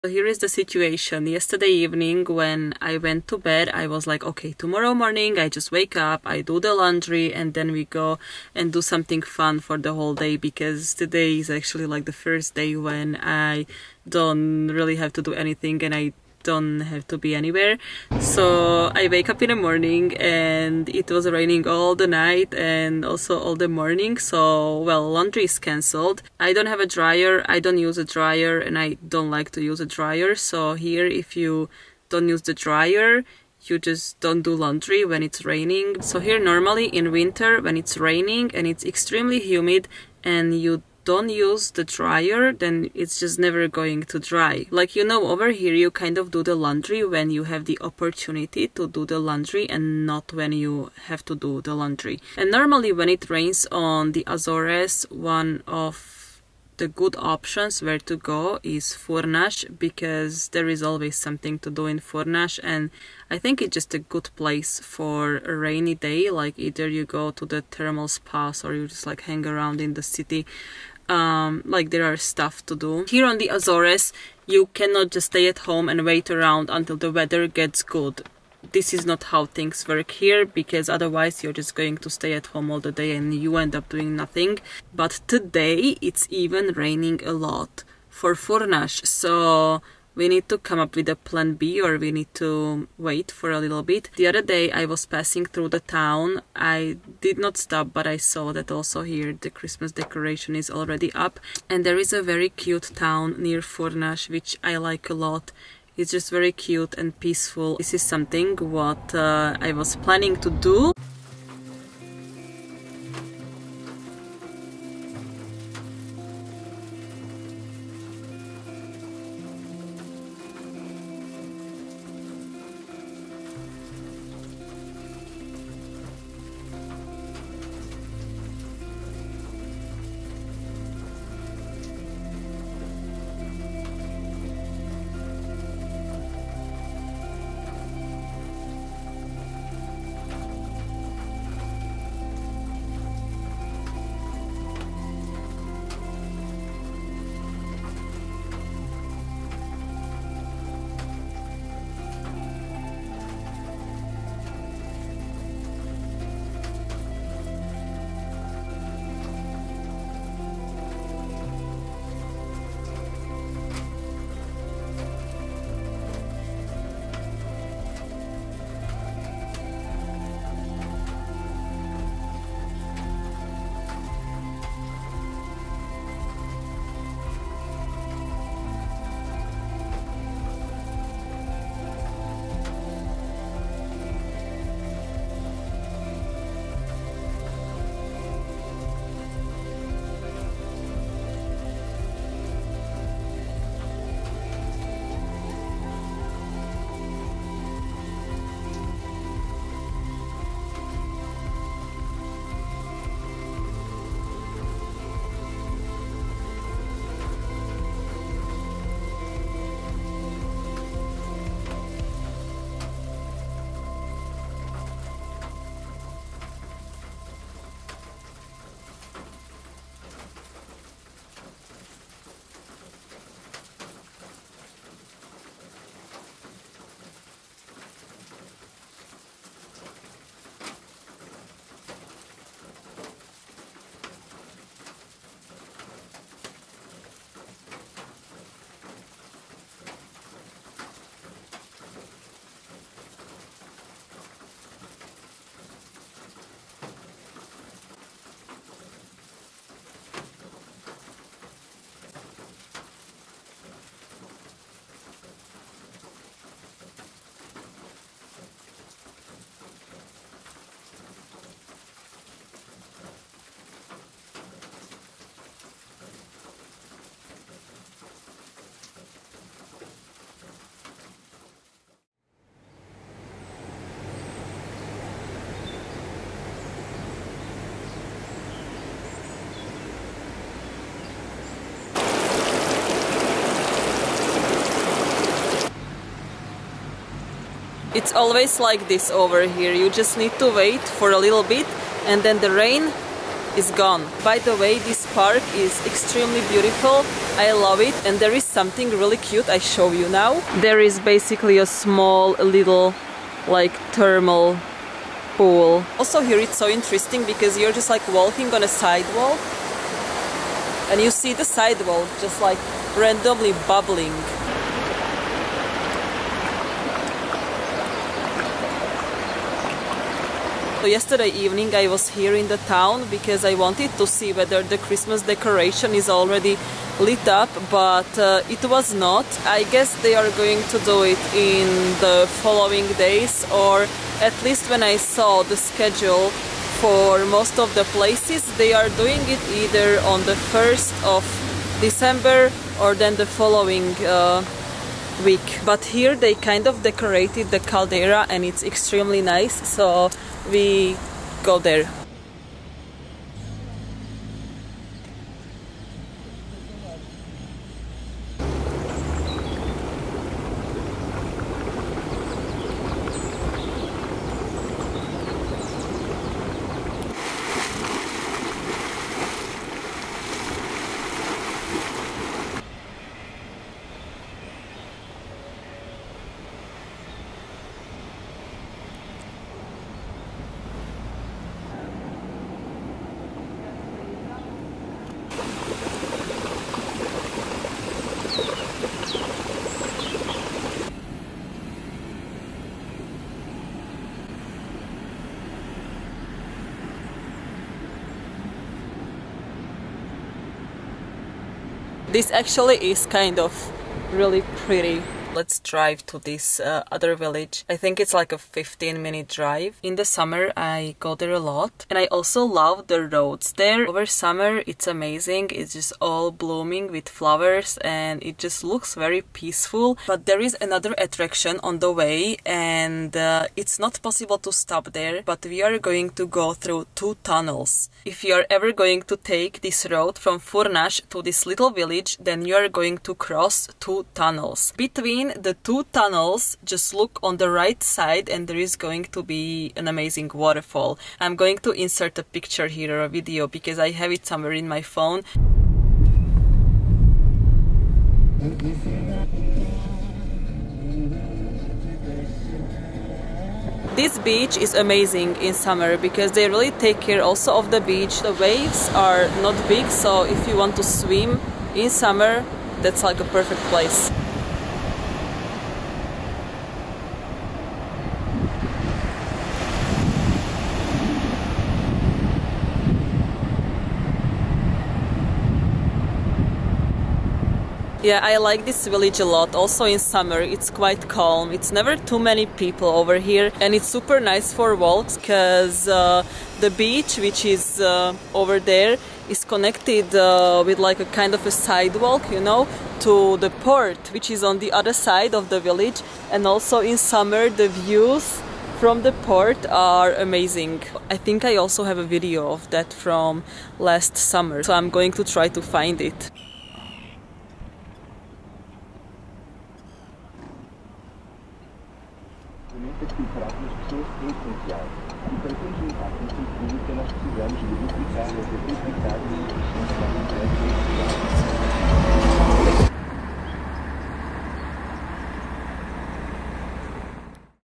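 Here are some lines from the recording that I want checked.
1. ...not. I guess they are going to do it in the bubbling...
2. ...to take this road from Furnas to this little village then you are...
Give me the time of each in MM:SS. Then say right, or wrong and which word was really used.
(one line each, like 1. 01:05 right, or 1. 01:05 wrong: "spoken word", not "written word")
1. 05:28 wrong: "following", not "bubbling"
2. 07:09 right.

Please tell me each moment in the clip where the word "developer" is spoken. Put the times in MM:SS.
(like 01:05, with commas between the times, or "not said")
not said.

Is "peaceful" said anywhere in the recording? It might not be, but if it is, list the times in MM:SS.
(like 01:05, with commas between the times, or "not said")
01:47, 06:59.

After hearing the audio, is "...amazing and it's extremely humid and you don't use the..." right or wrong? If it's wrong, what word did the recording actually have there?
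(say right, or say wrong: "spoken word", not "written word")
wrong: "raining", not "amazing".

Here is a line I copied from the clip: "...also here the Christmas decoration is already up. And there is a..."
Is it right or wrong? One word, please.
right.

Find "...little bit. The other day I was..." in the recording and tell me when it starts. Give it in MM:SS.
01:33.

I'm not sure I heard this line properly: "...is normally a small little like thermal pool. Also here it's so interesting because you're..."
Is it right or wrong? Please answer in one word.
wrong.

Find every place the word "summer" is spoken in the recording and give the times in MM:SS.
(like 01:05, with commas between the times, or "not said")
06:50, 06:54, 07:35, 07:41, 07:59, 08:16, 08:24.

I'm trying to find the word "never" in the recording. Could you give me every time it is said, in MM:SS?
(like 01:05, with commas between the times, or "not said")
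00:43, 08:01.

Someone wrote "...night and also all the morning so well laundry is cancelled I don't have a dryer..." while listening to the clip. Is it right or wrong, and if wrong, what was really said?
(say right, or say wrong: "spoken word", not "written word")
right.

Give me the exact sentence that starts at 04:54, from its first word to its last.
By the way, this park is extremely beautiful.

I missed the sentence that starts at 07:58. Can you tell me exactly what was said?
Yeah, I like this village a lot.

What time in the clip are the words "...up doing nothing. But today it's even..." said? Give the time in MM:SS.
01:23.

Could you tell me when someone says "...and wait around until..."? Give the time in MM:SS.
01:15.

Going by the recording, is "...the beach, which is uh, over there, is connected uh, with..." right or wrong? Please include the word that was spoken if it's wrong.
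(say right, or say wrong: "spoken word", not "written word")
right.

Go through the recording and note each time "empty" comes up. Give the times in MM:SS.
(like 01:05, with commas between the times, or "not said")
not said.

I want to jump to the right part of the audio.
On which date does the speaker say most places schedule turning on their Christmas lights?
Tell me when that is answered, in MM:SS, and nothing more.
05:40.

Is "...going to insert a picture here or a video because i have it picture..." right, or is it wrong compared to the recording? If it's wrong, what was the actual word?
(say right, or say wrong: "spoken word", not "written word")
wrong: "somewhere", not "picture".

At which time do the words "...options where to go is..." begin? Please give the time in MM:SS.
00:57.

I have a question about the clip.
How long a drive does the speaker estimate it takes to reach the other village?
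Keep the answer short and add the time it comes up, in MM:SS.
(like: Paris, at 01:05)
15 minutes, at 06:48.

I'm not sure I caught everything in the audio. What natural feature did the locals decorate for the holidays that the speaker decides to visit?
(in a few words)
the caldera.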